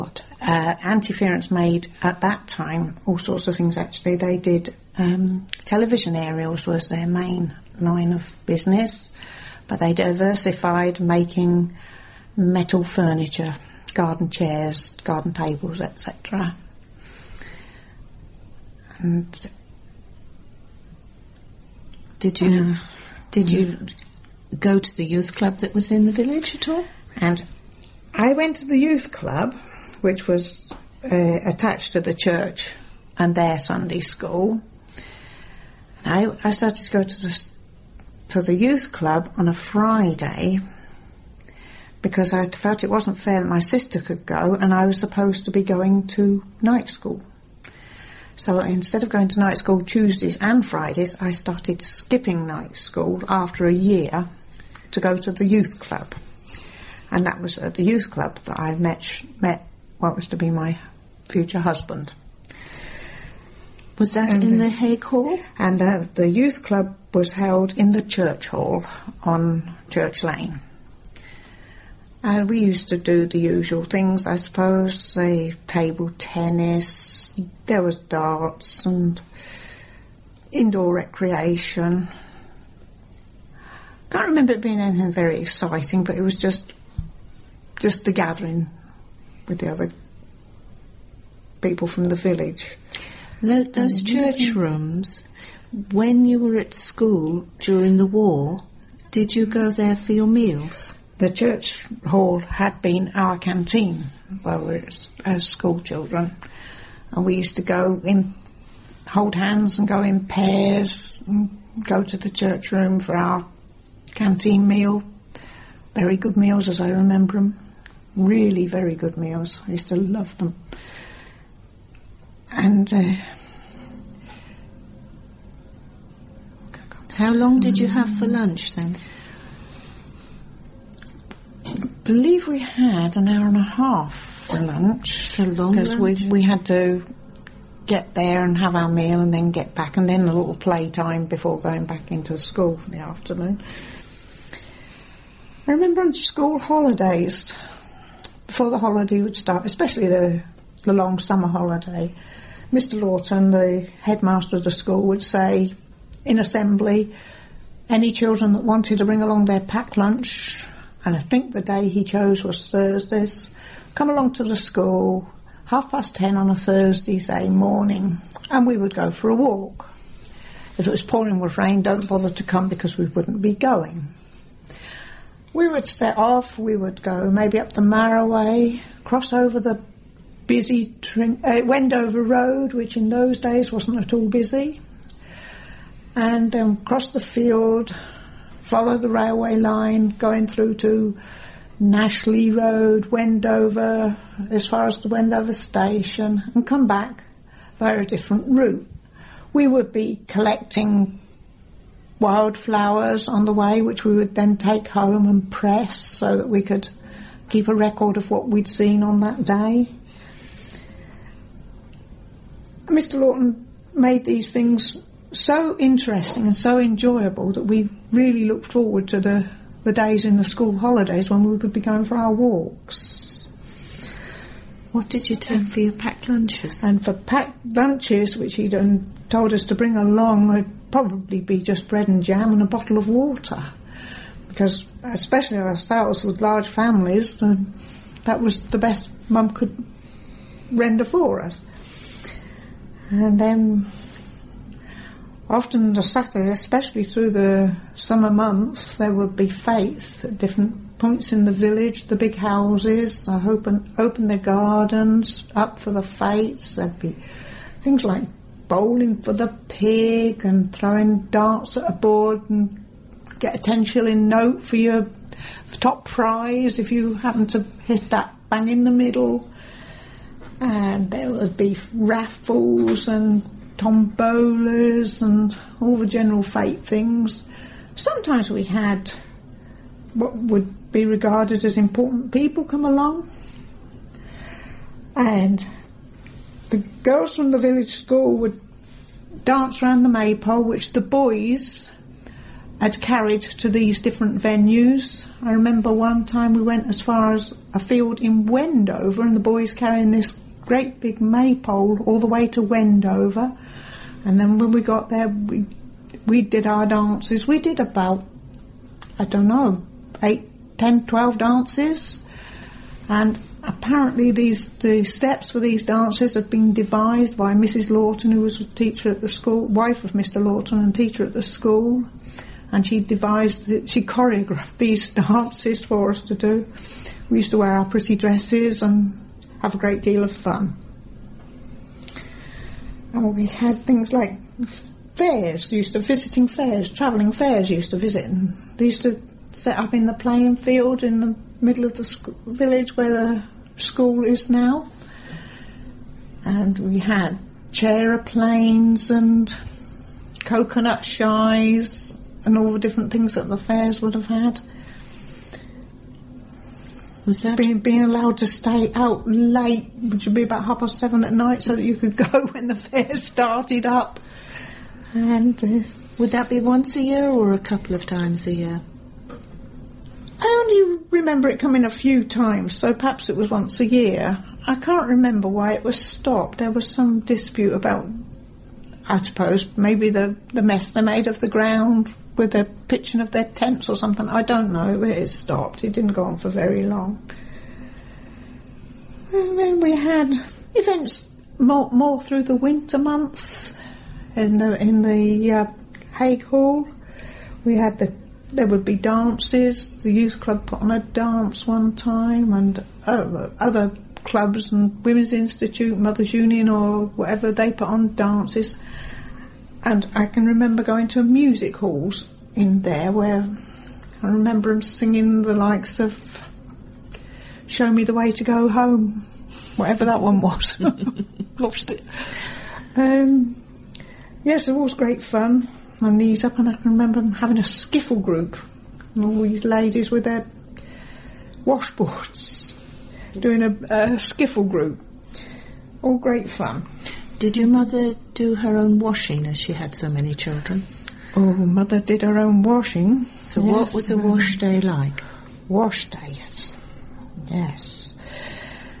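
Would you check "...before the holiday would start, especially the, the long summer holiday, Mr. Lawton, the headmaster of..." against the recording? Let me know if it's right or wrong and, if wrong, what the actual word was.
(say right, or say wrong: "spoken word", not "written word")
right.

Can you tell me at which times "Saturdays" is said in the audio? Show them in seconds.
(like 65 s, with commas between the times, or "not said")
246 s.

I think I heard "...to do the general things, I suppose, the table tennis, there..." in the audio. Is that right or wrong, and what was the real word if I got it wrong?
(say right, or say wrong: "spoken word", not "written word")
wrong: "usual", not "general".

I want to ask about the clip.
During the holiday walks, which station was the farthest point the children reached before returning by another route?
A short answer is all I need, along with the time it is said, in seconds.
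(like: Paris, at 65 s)
Wendover station, at 195 s.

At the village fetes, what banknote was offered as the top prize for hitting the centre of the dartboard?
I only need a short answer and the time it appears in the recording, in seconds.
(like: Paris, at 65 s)
10 shilling note, at 263 s.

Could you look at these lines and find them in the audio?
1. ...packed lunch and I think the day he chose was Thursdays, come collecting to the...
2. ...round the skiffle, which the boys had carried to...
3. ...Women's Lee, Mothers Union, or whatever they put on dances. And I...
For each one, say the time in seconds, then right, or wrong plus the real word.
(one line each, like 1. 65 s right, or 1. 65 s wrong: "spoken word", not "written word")
1. 159 s wrong: "along", not "collecting"
2. 289 s wrong: "maypole", not "skiffle"
3. 405 s wrong: "Institute", not "Lee".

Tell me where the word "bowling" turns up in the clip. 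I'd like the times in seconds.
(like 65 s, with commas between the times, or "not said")
258 s.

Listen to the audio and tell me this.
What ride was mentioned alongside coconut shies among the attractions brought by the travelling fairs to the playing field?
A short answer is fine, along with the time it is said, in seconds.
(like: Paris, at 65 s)
Chair planes, at 347 s.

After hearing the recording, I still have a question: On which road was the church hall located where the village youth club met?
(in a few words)
Church Lane.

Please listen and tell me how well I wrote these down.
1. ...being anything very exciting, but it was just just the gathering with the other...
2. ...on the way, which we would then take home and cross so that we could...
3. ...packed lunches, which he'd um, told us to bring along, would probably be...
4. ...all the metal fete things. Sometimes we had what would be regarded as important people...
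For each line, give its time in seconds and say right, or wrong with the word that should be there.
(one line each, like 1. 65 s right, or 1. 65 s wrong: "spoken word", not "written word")
1. 84 s right
2. 203 s wrong: "press", not "cross"
3. 227 s right
4. 275 s wrong: "general", not "metal".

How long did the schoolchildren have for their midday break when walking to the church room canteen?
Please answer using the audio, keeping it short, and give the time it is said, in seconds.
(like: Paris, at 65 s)
An hour and a half, at 133 s.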